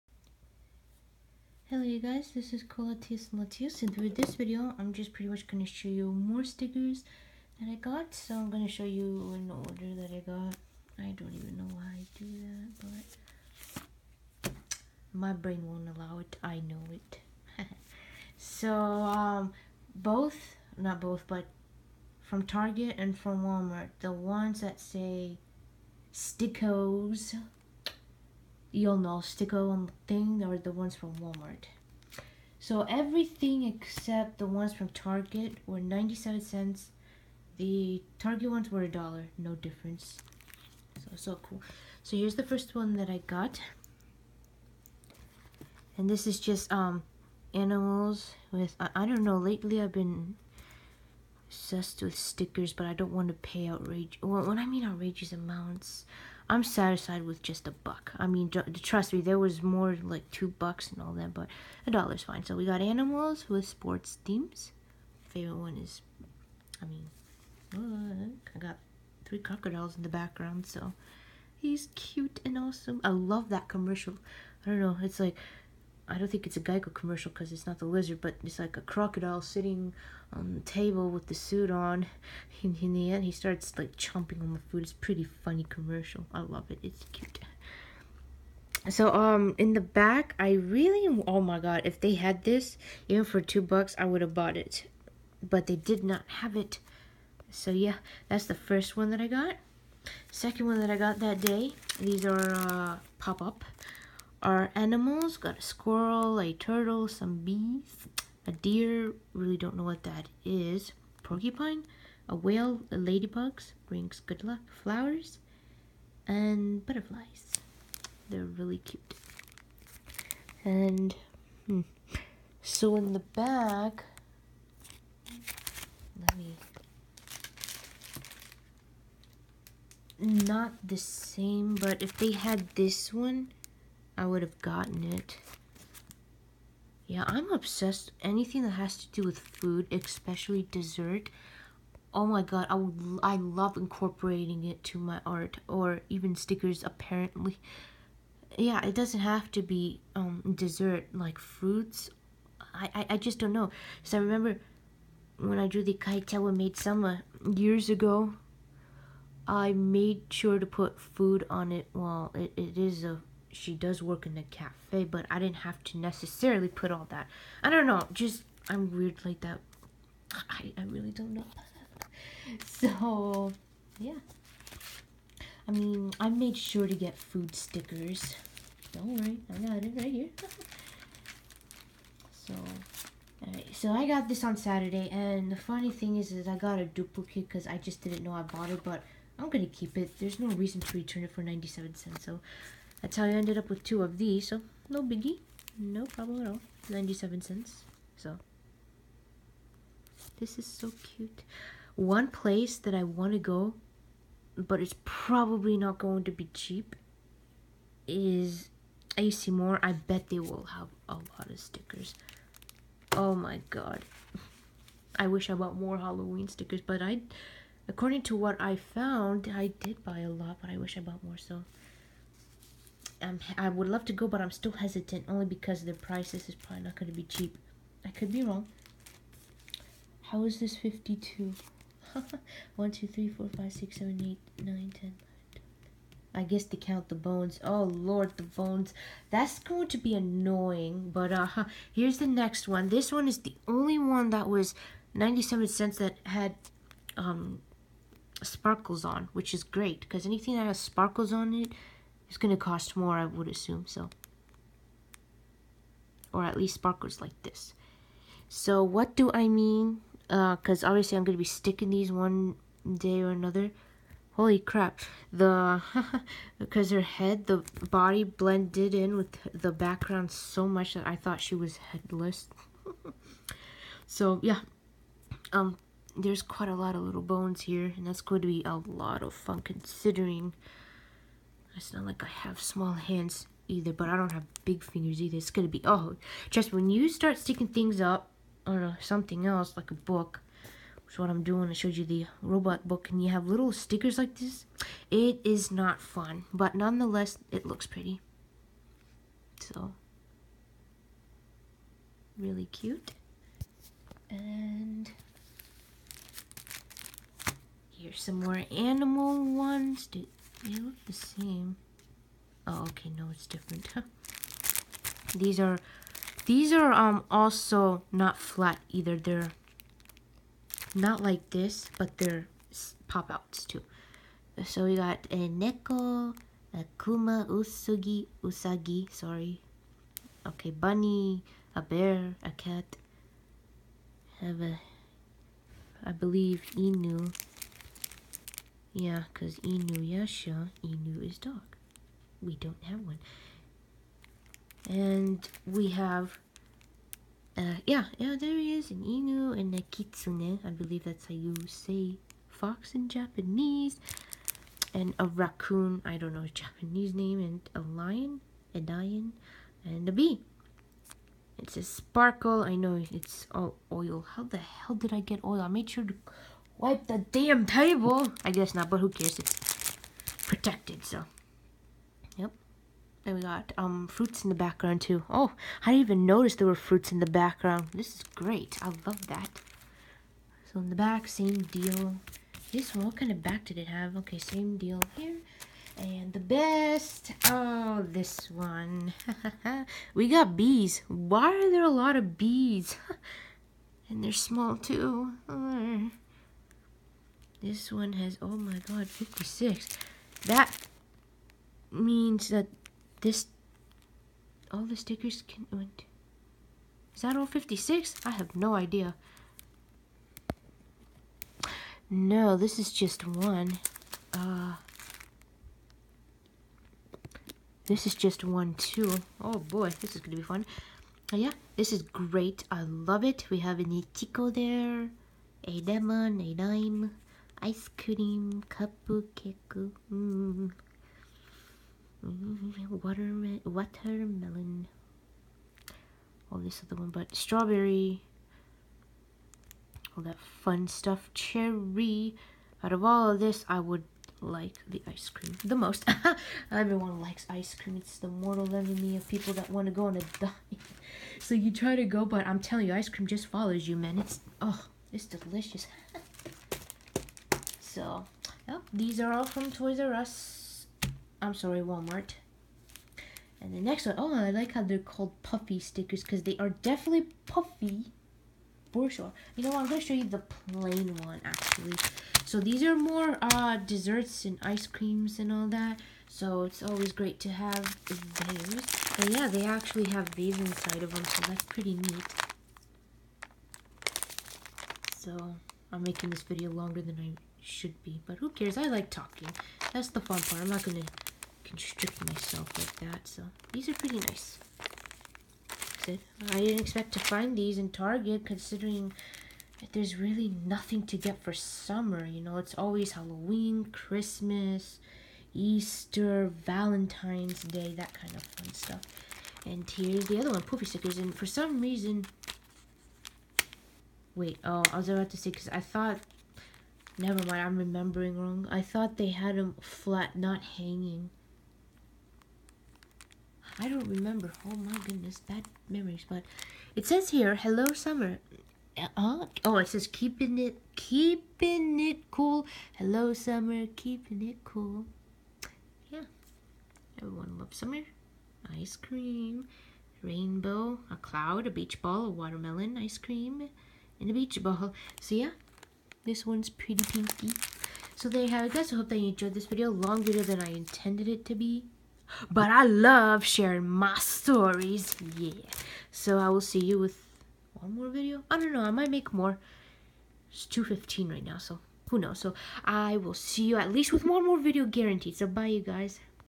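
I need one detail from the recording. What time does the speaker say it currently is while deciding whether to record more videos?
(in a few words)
2:15.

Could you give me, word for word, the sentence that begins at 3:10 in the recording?
There's no reason to return it for 97 cents, so that's how I ended up with two of these, so no biggie.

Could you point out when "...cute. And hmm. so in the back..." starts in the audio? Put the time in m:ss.
1:58.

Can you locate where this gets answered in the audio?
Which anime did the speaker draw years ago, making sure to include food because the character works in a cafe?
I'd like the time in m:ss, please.
2:35.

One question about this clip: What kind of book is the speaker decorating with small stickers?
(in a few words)
robot book.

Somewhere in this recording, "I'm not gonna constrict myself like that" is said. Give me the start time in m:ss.
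8:10.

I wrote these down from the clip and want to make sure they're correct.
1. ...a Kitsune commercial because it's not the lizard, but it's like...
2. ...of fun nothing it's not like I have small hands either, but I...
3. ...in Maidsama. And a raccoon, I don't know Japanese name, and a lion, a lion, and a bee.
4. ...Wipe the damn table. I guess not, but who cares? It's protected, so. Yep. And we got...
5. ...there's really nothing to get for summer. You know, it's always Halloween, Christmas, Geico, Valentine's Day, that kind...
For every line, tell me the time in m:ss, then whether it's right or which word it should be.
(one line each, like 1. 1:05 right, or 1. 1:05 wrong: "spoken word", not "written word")
1. 1:16 wrong: "Geico", not "Kitsune"
2. 4:39 wrong: "considering", not "nothing"
3. 5:52 wrong: "Japanese", not "Maidsama"
4. 6:06 right
5. 8:19 wrong: "Easter", not "Geico".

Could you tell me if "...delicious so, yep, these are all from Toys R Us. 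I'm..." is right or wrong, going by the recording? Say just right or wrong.
right.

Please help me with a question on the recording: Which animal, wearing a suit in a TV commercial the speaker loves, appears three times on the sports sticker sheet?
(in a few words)
crocodile.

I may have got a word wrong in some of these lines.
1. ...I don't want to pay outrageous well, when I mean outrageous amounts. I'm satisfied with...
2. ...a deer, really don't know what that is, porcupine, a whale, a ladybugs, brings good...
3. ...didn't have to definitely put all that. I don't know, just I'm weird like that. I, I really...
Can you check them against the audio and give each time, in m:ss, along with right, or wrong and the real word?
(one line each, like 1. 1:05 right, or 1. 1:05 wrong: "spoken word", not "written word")
1. 0:52 right
2. 1:48 right
3. 2:45 wrong: "necessarily", not "definitely".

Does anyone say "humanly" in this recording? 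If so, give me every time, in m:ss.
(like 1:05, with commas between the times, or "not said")
not said.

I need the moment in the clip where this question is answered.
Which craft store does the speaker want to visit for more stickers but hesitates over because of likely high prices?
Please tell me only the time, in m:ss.
3:29.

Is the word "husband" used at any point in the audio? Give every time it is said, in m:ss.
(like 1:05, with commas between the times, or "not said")
not said.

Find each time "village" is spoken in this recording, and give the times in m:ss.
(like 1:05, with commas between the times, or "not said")
not said.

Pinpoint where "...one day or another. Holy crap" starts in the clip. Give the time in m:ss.
4:22.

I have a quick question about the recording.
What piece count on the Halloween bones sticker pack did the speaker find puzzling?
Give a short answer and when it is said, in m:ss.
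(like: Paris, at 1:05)
52, at 3:50.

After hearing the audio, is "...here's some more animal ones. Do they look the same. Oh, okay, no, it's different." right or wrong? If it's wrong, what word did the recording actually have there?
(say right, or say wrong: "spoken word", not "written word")
right.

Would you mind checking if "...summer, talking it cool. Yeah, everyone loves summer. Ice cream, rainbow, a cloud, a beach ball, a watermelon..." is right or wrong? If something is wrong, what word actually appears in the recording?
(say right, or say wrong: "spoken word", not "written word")
wrong: "keeping", not "talking".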